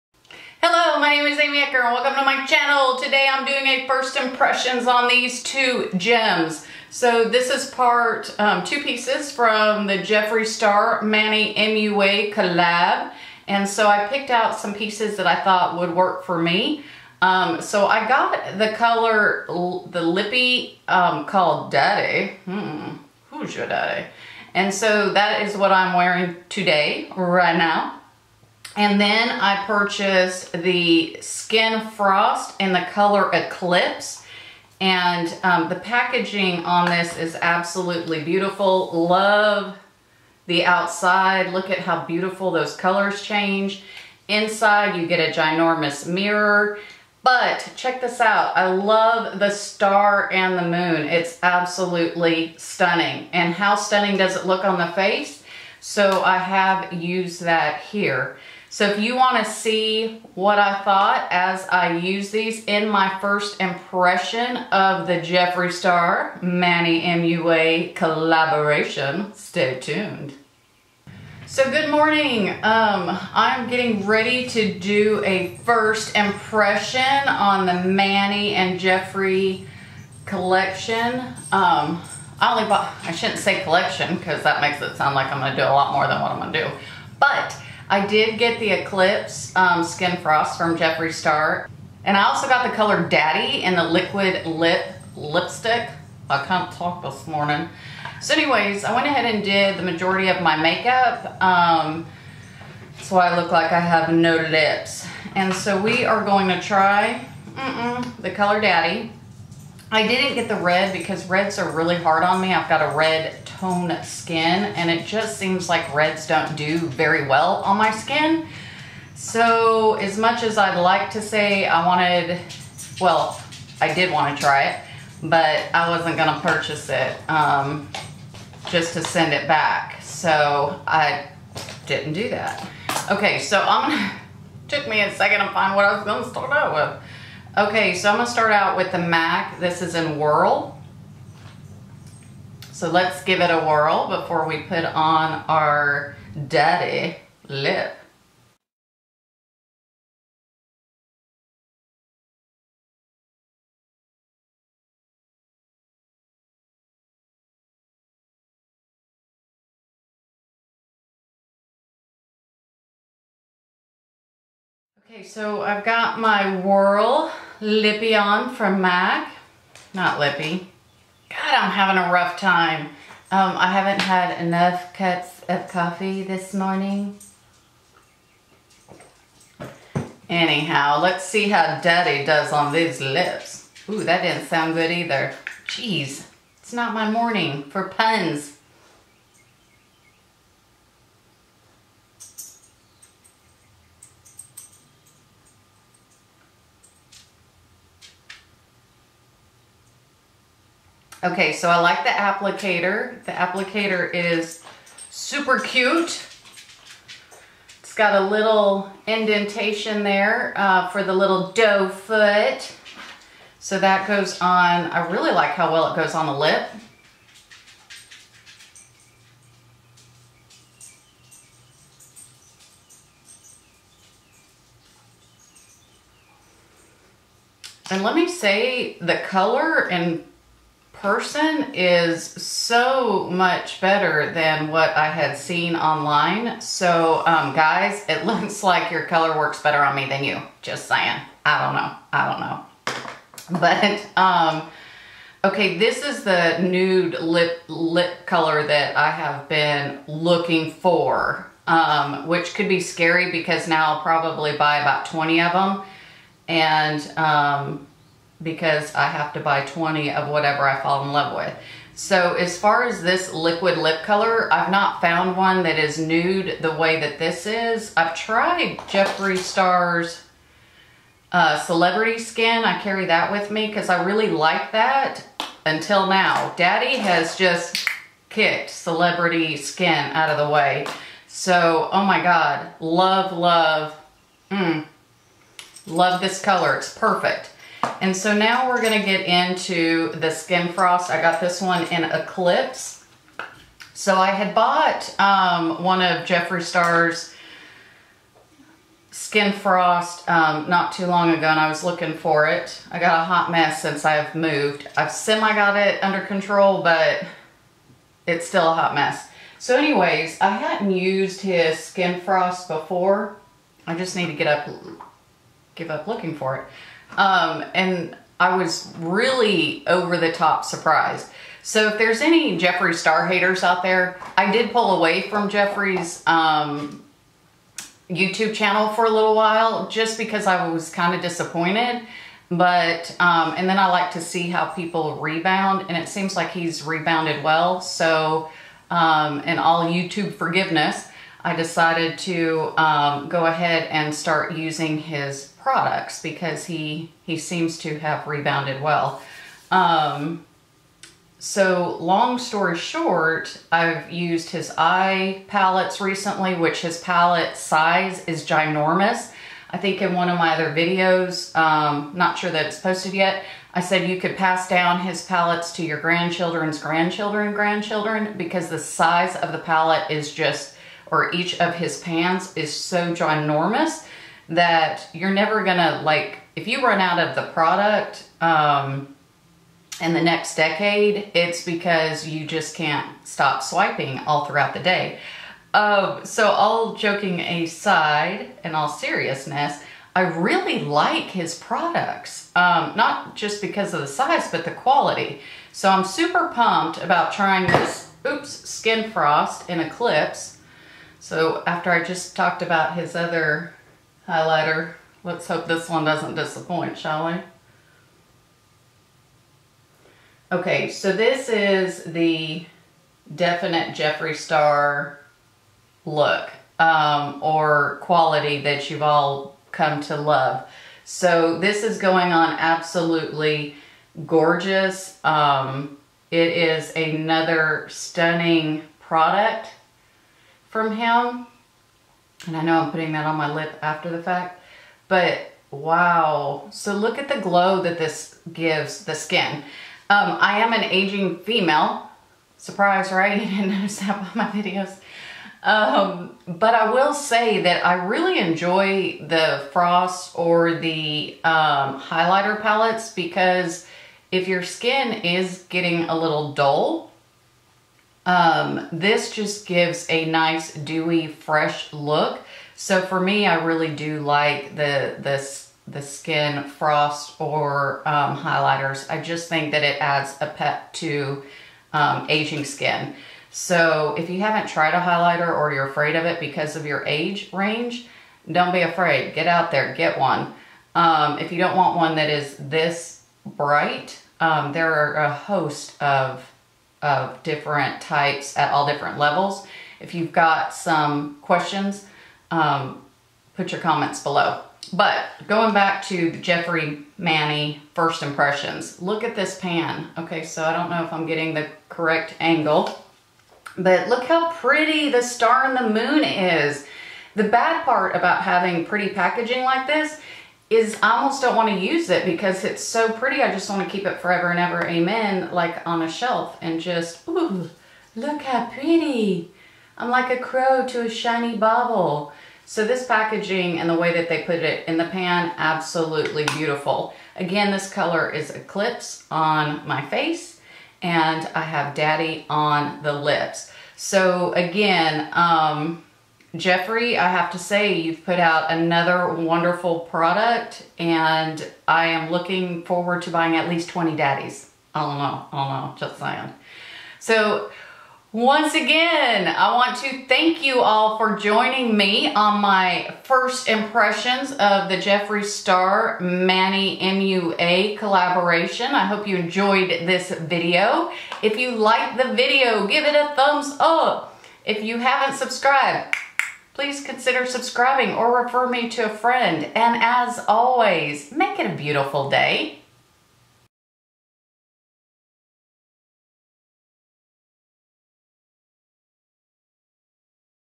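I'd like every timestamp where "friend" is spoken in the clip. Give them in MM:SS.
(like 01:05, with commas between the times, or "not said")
09:29.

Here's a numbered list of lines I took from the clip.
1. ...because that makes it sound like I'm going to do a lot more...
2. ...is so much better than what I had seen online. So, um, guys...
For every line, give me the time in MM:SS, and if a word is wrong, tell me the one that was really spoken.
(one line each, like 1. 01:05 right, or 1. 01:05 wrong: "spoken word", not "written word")
1. 01:24 right
2. 03:51 right.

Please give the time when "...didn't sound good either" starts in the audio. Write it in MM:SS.
03:04.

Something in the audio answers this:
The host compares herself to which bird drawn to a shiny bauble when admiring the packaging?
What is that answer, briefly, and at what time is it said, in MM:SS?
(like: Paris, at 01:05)
crow, at 08:40.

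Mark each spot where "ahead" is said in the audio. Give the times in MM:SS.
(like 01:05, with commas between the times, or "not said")
01:39, 05:43.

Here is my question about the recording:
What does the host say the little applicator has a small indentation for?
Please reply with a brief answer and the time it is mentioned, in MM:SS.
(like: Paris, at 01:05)
doe foot, at 03:31.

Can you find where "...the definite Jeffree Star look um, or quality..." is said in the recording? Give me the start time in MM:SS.
06:52.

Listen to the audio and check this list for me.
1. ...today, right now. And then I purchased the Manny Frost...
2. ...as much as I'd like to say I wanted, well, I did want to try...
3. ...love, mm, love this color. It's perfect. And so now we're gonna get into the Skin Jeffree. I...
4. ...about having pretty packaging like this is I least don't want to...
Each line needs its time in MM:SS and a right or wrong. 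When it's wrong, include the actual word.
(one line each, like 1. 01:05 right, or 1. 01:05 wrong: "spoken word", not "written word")
1. 00:26 wrong: "Skin", not "Manny"
2. 01:59 right
3. 04:43 wrong: "Frost", not "Jeffree"
4. 08:28 wrong: "almost", not "least".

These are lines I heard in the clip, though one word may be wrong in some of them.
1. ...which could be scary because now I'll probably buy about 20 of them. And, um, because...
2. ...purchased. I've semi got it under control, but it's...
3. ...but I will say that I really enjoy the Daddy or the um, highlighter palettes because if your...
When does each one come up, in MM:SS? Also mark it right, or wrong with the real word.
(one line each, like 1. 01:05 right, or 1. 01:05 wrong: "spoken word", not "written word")
1. 04:12 right
2. 05:04 wrong: "moved", not "purchased"
3. 07:26 wrong: "Frost", not "Daddy".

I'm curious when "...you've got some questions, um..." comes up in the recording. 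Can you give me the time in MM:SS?
08:10.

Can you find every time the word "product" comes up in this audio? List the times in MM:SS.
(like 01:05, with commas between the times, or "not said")
05:45, 06:17, 06:31, 07:08, 09:00.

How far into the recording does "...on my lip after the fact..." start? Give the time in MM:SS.
07:13.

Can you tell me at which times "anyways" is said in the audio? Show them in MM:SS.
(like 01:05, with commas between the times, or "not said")
01:38, 05:09.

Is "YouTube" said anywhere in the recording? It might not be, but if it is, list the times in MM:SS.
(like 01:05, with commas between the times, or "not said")
05:28, 05:39.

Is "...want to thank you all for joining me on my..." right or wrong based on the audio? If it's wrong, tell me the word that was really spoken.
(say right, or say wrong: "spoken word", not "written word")
right.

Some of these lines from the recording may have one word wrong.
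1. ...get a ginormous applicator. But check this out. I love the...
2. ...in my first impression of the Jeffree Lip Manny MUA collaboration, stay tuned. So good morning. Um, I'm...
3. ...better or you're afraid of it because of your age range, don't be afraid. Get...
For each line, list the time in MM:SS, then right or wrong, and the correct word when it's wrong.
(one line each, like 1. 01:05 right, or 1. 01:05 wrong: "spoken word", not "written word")
1. 00:45 wrong: "mirror", not "applicator"
2. 01:02 wrong: "Star", not "Lip"
3. 07:55 wrong: "highlighter", not "better".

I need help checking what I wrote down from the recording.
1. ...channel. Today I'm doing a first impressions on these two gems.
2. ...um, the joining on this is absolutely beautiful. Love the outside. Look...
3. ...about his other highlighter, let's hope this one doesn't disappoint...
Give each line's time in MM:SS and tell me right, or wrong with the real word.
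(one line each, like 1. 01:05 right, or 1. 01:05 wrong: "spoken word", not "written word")
1. 00:02 right
2. 00:35 wrong: "packaging", not "joining"
3. 06:42 right.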